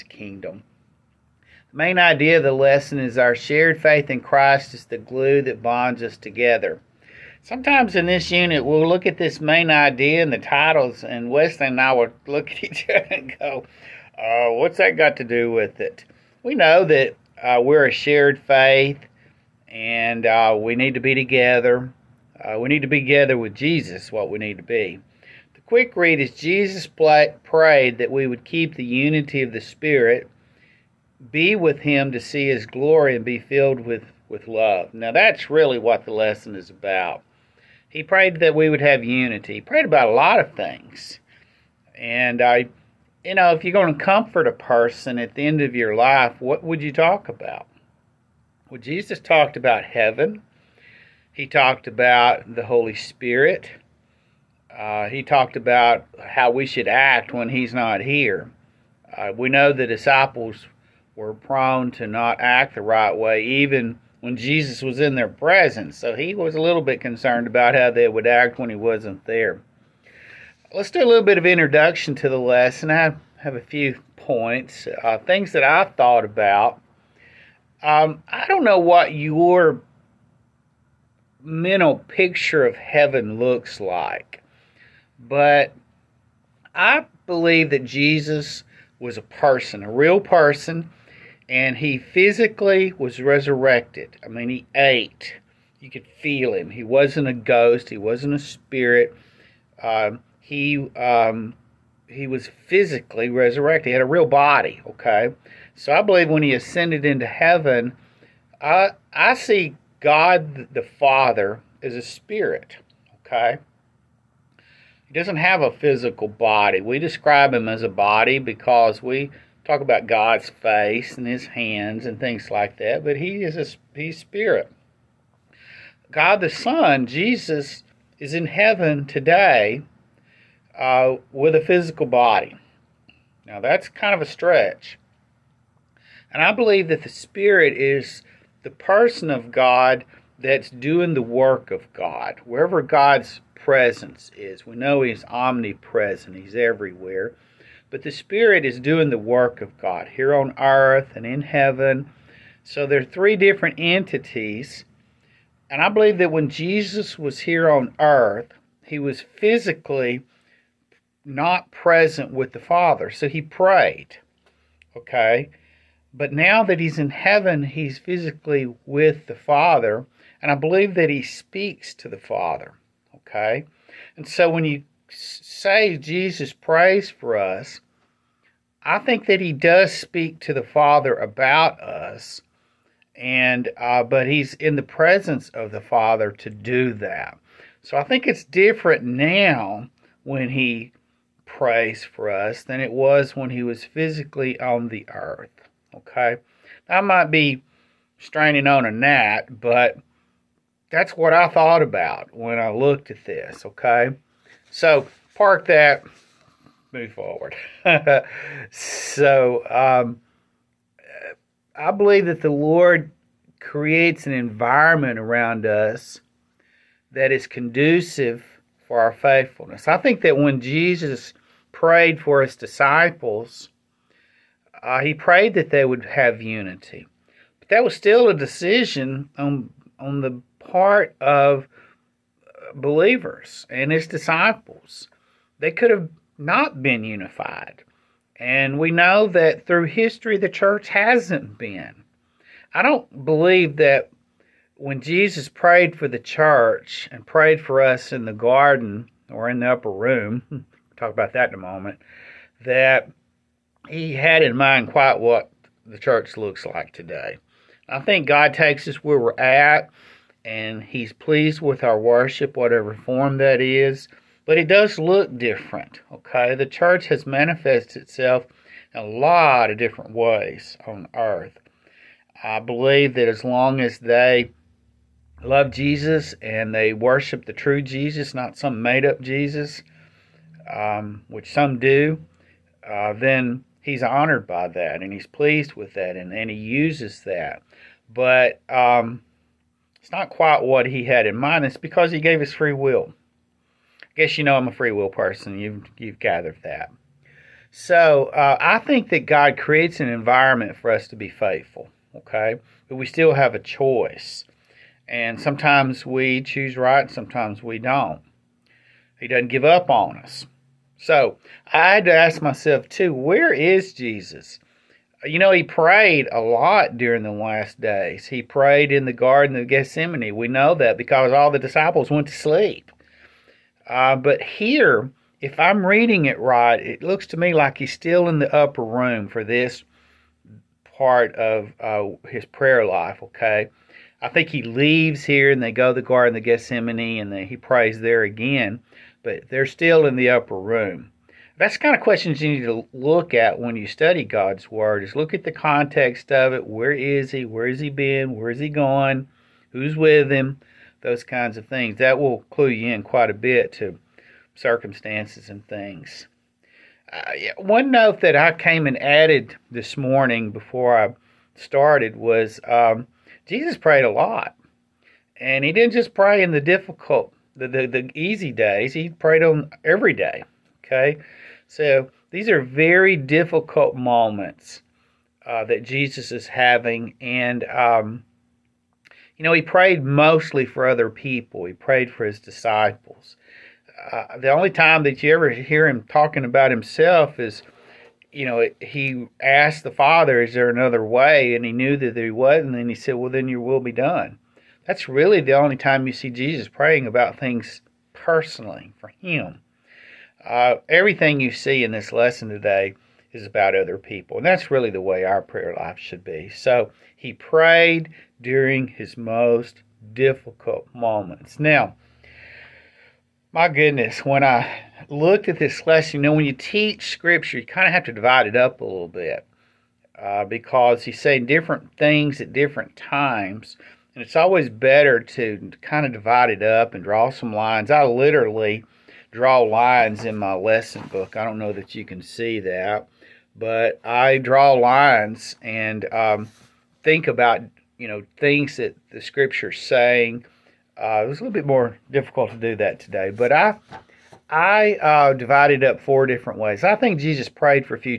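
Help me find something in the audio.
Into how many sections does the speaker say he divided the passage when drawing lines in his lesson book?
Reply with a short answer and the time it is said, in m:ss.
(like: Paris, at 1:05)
4, at 7:26.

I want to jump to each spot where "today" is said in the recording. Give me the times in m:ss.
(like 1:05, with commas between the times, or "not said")
2:09, 4:16, 6:42, 7:22.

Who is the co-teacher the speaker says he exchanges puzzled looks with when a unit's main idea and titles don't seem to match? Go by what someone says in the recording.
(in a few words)
Wesley.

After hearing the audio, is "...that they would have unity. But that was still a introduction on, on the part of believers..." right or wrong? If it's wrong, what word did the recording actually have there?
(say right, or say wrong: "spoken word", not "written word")
wrong: "decision", not "introduction".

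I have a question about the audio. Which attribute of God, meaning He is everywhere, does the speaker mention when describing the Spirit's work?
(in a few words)
omnipresent.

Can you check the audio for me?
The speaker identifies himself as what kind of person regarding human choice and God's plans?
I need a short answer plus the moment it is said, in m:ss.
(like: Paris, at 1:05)
a free will person, at 4:54.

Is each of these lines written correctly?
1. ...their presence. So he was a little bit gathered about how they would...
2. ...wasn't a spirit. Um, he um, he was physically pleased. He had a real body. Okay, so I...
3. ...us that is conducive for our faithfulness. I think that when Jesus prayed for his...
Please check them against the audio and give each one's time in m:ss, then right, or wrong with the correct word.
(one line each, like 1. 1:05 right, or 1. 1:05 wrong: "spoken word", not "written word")
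1. 1:05 wrong: "concerned", not "gathered"
2. 1:37 wrong: "resurrected", not "pleased"
3. 3:35 right.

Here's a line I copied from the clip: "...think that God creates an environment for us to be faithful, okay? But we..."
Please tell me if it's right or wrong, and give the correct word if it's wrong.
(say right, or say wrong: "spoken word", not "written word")
right.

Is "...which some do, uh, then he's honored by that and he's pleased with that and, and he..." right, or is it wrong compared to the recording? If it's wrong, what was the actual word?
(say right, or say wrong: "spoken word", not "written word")
right.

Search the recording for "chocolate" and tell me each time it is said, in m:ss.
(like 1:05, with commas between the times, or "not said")
not said.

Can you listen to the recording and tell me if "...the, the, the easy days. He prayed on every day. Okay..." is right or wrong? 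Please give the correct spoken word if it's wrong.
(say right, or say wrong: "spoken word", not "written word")
right.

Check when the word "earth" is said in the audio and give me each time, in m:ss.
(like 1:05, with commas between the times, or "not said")
2:30, 2:37, 3:15, 4:31.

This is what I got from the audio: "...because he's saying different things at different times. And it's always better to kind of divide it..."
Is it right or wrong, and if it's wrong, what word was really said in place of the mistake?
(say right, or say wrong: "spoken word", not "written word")
right.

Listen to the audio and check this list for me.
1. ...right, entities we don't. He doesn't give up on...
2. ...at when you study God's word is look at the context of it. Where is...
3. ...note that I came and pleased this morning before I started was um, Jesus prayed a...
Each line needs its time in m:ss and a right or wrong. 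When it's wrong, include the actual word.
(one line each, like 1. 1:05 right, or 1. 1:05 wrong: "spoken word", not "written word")
1. 5:06 wrong: "sometimes", not "entities"
2. 5:43 right
3. 5:57 wrong: "added", not "pleased".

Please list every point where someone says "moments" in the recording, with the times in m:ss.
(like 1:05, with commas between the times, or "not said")
4:11, 6:13, 6:50.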